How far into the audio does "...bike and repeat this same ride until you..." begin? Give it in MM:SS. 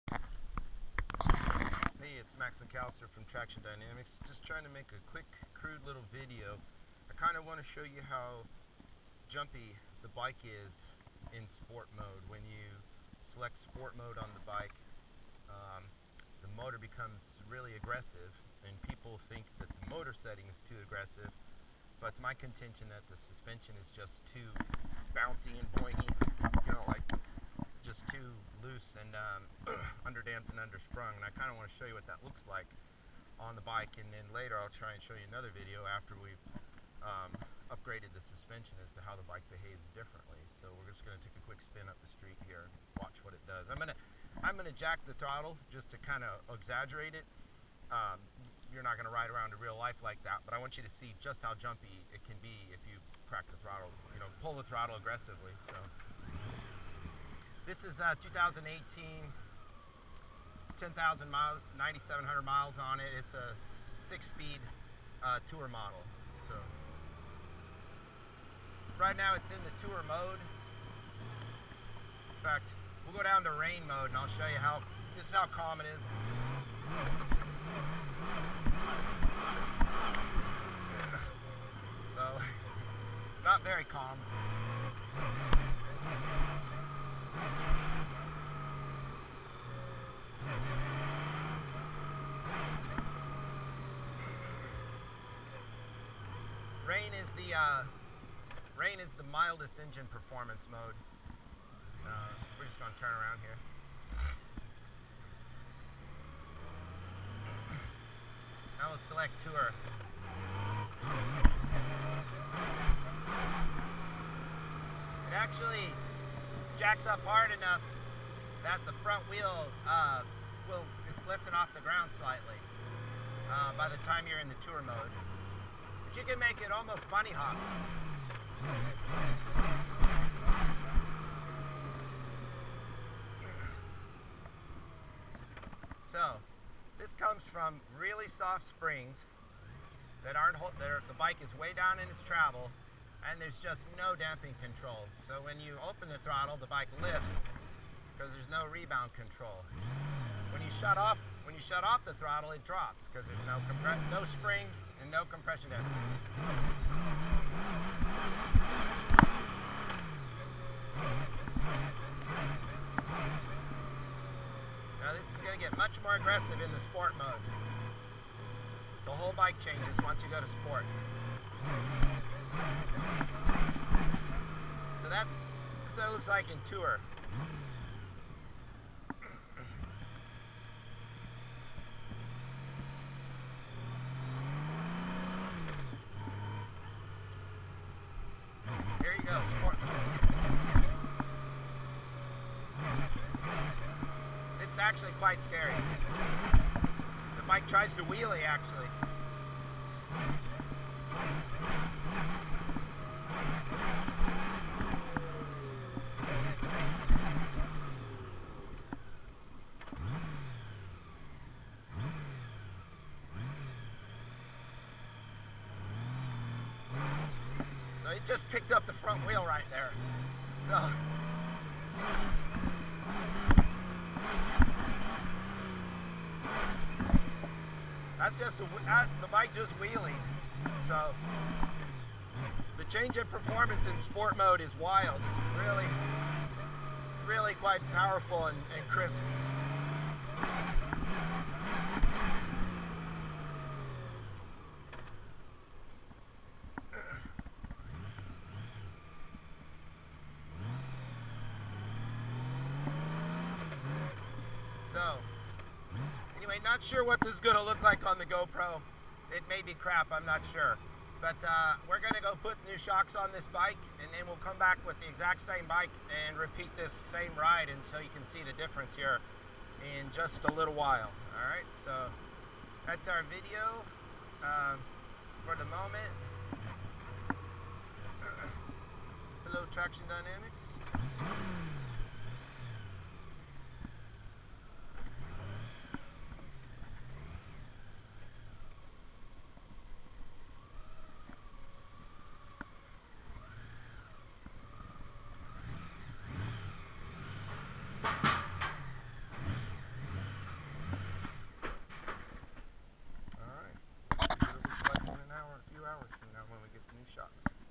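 04:25.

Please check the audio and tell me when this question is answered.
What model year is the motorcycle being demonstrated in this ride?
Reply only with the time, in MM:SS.
00:58.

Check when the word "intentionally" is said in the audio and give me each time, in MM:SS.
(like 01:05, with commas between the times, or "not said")
not said.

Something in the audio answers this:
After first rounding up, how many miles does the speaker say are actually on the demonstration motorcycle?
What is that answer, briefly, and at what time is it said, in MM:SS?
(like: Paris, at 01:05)
9,700, at 01:01.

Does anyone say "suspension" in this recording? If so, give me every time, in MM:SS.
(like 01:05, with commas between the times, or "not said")
00:23, 00:38.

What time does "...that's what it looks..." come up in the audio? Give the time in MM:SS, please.
02:55.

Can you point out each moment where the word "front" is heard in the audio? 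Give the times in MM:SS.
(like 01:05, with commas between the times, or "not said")
01:59, 03:38.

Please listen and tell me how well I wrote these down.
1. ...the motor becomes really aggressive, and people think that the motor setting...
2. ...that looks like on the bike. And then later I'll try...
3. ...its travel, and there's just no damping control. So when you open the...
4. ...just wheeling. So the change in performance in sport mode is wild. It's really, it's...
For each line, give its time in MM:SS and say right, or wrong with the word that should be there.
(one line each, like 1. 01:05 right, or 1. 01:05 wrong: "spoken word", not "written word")
1. 00:16 right
2. 00:32 right
3. 02:22 right
4. 03:49 right.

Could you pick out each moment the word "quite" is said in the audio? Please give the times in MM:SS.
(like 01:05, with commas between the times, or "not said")
03:15, 03:57.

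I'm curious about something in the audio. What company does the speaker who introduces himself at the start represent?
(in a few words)
Traxxion Dynamics.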